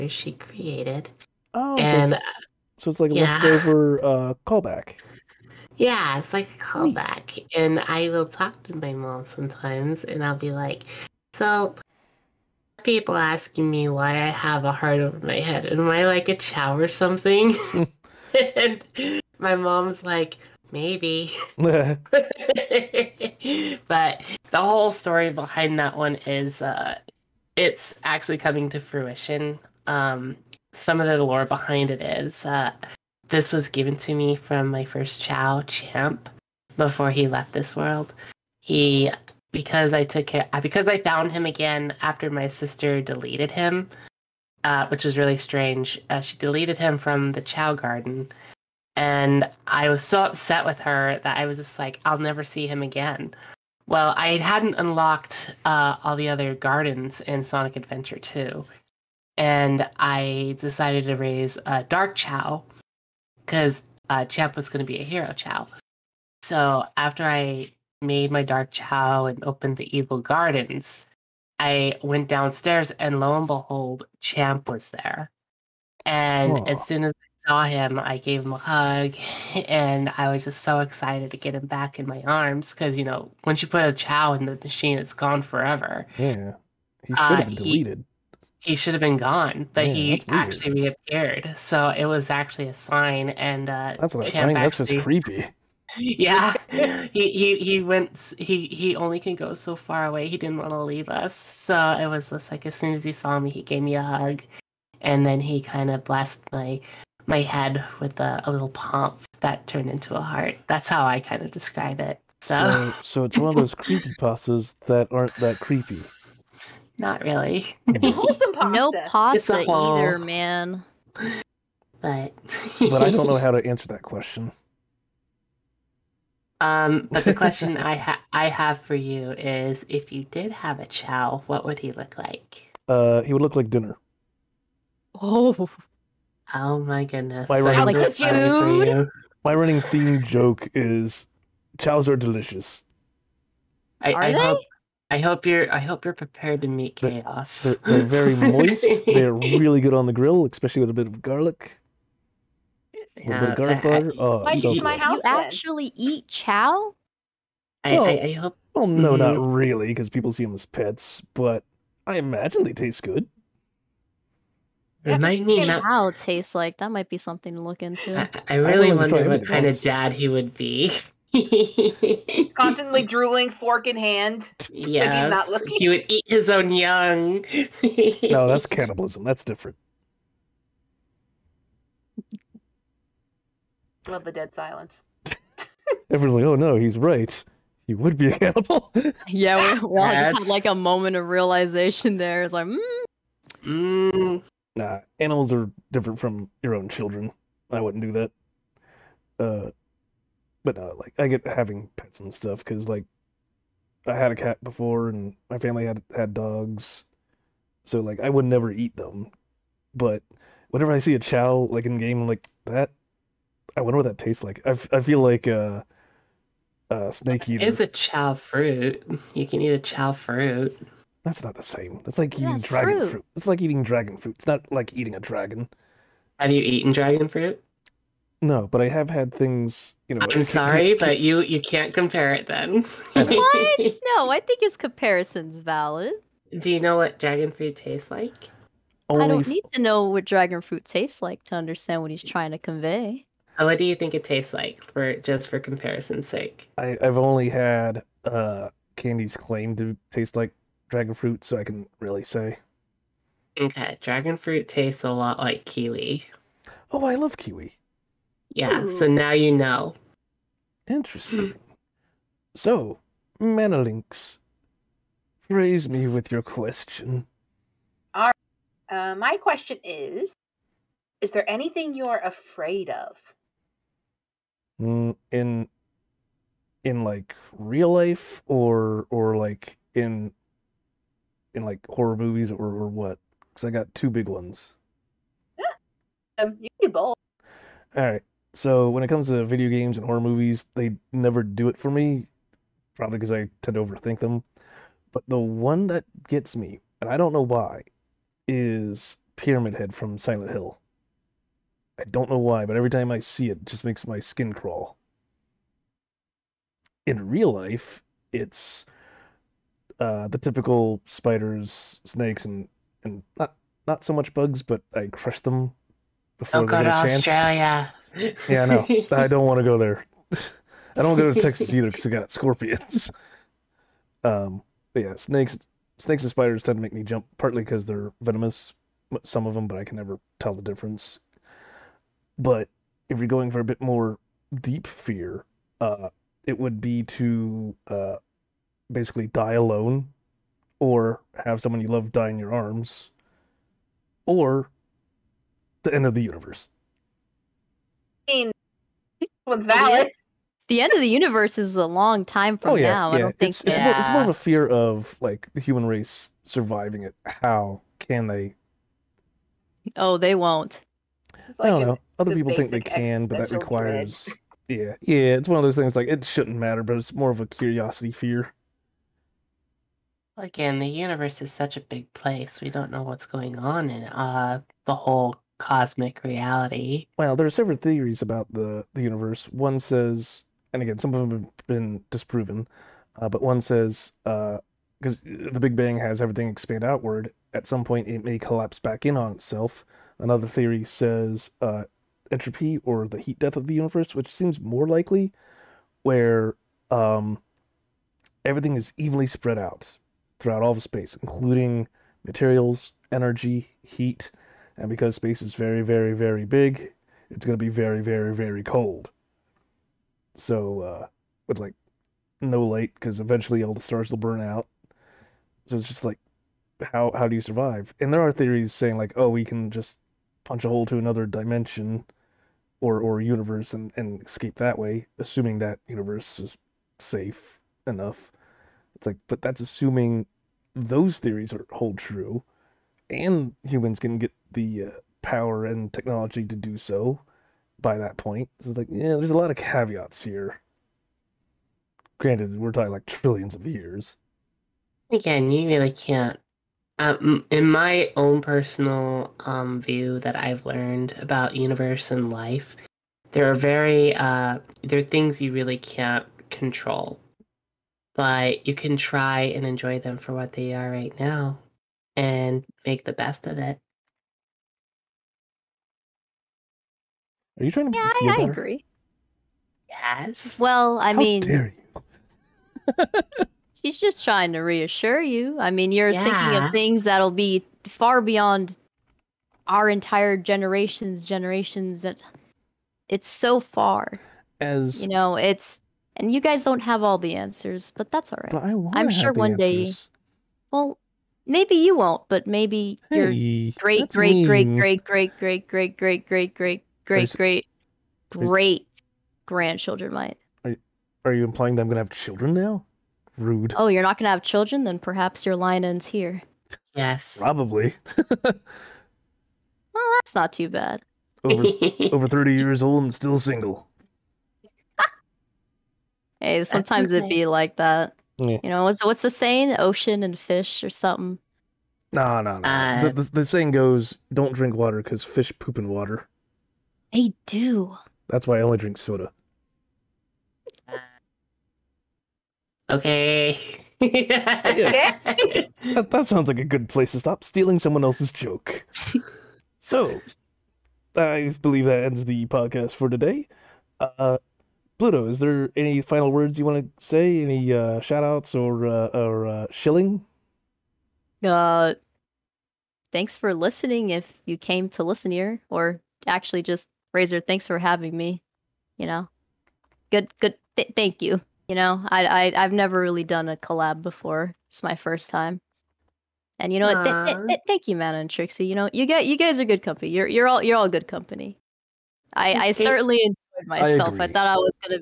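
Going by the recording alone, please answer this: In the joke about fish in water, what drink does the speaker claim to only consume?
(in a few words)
Soda.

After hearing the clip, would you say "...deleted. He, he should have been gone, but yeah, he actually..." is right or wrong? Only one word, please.
right.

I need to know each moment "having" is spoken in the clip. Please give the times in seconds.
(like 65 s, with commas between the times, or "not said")
201 s, 557 s.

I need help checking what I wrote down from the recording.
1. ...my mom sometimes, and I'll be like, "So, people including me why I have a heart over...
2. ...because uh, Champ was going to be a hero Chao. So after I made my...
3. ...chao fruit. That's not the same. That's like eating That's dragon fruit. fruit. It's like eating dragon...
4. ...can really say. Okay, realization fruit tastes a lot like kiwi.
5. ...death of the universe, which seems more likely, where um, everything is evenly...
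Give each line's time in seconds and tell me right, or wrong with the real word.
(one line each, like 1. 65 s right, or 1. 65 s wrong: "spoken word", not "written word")
1. 8 s wrong: "asking", not "including"
2. 63 s right
3. 219 s right
4. 251 s wrong: "dragon", not "realization"
5. 393 s right.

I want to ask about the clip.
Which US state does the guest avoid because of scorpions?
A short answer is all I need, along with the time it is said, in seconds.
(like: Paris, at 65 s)
Texas, at 321 s.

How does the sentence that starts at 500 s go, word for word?
Are, are you implying that I'm gonna have children now?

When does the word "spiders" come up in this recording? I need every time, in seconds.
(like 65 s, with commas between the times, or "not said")
311 s, 326 s.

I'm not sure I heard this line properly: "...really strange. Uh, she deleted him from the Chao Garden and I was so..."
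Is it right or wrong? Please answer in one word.
right.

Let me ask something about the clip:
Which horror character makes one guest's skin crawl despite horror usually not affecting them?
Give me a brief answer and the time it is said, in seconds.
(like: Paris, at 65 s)
Pyramid Head, at 299 s.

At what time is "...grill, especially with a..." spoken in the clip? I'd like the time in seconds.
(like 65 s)
150 s.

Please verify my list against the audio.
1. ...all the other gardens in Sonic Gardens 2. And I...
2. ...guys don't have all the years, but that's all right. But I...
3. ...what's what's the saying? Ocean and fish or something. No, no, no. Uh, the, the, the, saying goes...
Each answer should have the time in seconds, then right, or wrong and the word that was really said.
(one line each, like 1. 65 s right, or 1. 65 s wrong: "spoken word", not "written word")
1. 56 s wrong: "Adventure", not "Gardens"
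2. 486 s wrong: "answers", not "years"
3. 518 s right.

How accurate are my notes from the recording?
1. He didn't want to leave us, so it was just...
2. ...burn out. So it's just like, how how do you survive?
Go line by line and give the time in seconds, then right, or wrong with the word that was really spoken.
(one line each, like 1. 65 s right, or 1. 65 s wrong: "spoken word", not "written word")
1. 100 s right
2. 414 s right.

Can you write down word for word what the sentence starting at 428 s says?
It's like, but that's assuming those theories are hold true, and humans can get the uh, power and technology to do so.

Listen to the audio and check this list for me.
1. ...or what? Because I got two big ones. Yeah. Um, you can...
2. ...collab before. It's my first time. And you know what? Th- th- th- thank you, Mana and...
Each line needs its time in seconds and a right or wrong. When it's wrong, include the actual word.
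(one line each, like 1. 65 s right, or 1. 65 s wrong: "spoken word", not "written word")
1. 282 s right
2. 563 s right.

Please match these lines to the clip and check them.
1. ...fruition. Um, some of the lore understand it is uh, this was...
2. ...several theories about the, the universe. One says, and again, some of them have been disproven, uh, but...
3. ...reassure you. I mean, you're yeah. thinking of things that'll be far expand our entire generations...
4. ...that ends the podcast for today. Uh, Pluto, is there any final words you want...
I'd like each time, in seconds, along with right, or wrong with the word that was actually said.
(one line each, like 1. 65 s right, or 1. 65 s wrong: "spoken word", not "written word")
1. 28 s wrong: "behind", not "understand"
2. 377 s right
3. 474 s wrong: "beyond", not "expand"
4. 541 s right.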